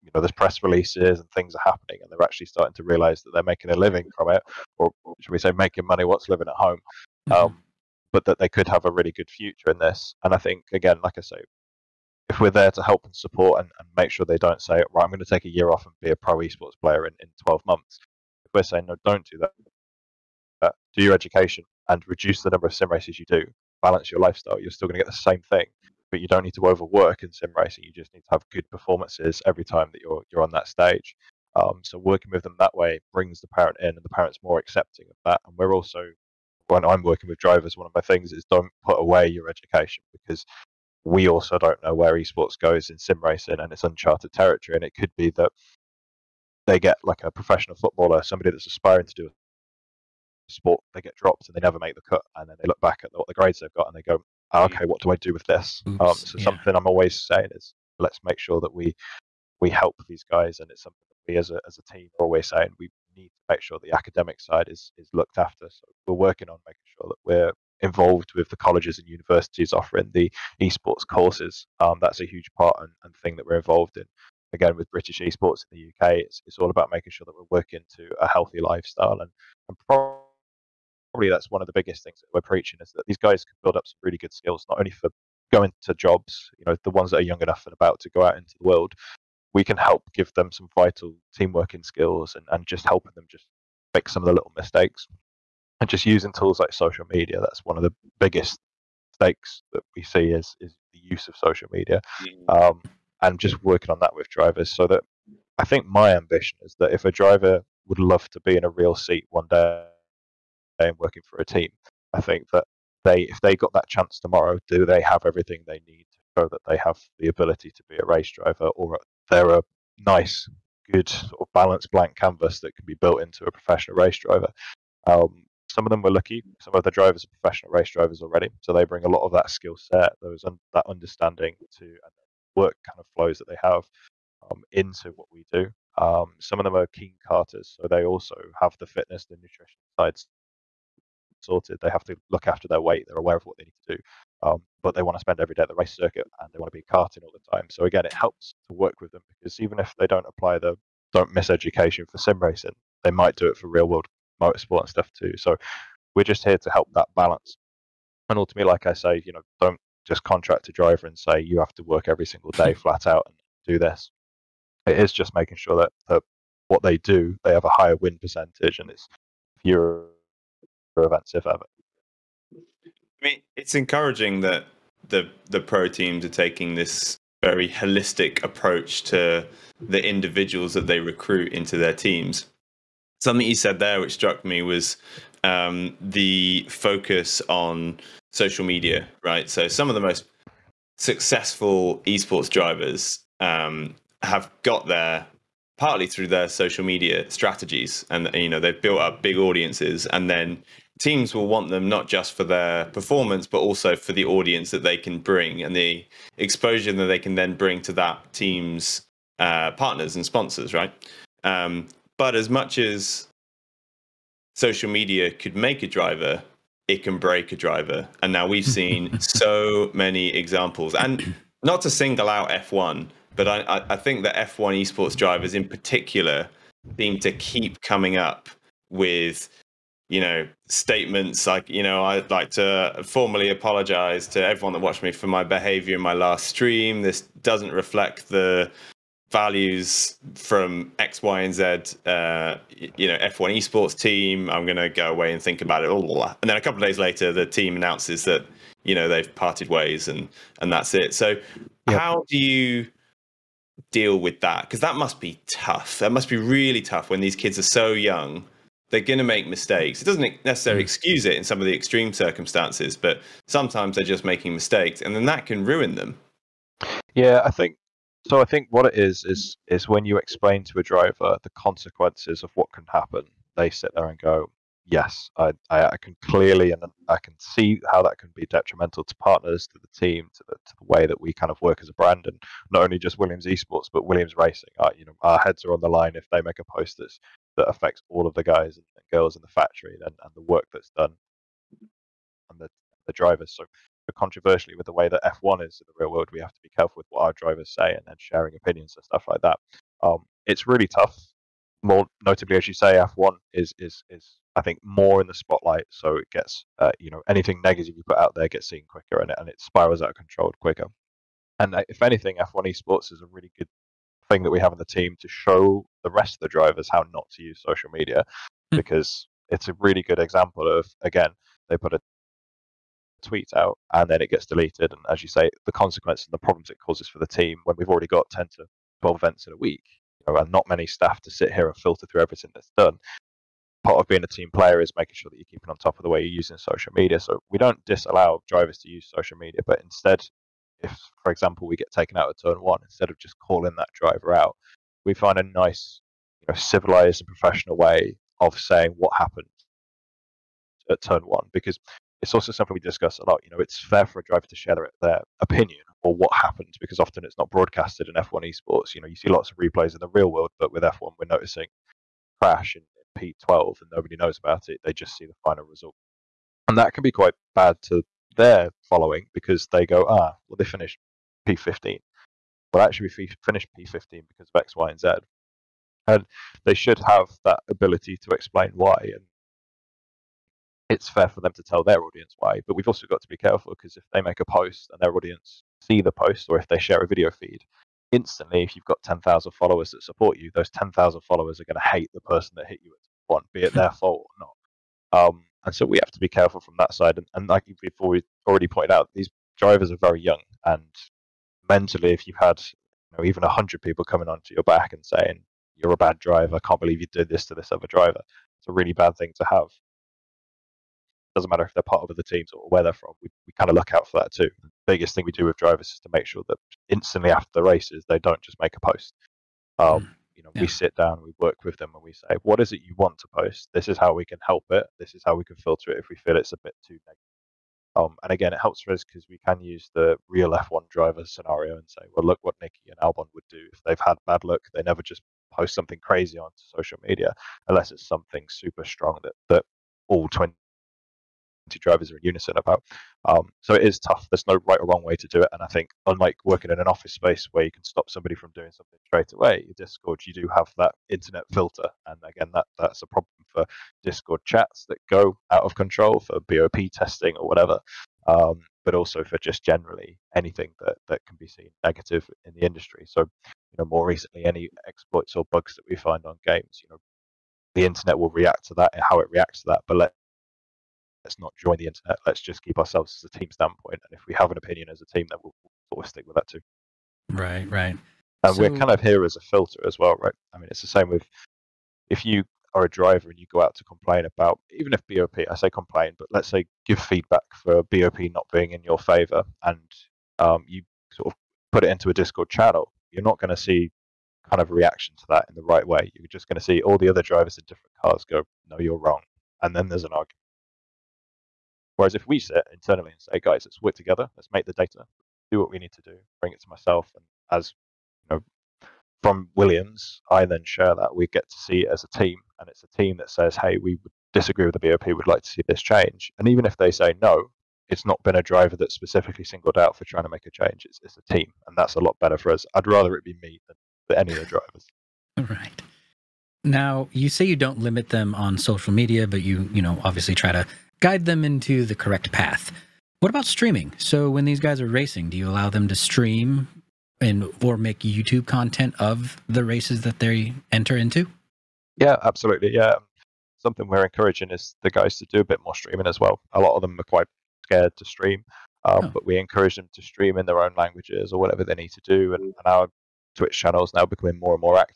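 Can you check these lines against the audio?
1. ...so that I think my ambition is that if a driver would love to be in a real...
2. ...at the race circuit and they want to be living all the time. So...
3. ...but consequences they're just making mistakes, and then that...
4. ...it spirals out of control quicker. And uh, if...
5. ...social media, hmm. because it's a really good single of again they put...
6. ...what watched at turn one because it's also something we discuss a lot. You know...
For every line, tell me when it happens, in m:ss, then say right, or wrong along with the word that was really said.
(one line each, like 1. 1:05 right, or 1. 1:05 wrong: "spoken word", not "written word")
1. 1:44 right
2. 2:25 wrong: "karting", not "living"
3. 4:22 wrong: "sometimes", not "consequences"
4. 5:09 right
5. 5:17 wrong: "example", not "single"
6. 5:48 wrong: "happened", not "watched".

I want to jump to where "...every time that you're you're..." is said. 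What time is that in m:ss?
0:29.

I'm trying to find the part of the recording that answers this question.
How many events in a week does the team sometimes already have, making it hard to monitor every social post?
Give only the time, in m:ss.
5:28.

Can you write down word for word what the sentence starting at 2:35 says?
So we're just here to help that balance.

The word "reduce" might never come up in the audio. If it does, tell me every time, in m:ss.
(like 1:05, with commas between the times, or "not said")
0:22.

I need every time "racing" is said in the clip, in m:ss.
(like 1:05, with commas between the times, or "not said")
0:27, 0:43, 2:32, 4:44, 8:54.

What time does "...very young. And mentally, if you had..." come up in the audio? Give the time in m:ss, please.
6:39.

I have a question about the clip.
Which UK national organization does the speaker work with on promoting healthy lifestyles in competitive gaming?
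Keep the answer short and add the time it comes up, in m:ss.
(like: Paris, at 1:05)
British esports, at 1:14.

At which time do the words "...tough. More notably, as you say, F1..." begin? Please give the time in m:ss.
5:00.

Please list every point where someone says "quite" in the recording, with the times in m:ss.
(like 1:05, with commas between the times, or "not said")
6:07, 9:07.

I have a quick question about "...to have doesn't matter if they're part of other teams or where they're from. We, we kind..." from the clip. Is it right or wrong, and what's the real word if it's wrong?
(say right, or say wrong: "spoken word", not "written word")
right.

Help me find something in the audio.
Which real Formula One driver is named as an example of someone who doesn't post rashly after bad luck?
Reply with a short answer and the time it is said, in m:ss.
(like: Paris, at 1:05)
Albon, at 7:12.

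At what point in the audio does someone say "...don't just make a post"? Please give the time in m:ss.
6:58.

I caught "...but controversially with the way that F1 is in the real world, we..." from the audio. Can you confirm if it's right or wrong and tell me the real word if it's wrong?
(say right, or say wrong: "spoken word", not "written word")
right.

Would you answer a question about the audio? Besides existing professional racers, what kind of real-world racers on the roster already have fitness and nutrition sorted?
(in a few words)
karters.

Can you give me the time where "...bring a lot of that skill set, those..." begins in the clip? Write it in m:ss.
2:08.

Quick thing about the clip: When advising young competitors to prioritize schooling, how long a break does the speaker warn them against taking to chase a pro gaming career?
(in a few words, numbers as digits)
a year.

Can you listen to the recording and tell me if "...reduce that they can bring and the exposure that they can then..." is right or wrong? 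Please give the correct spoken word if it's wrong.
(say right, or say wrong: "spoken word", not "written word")
wrong: "audience", not "reduce".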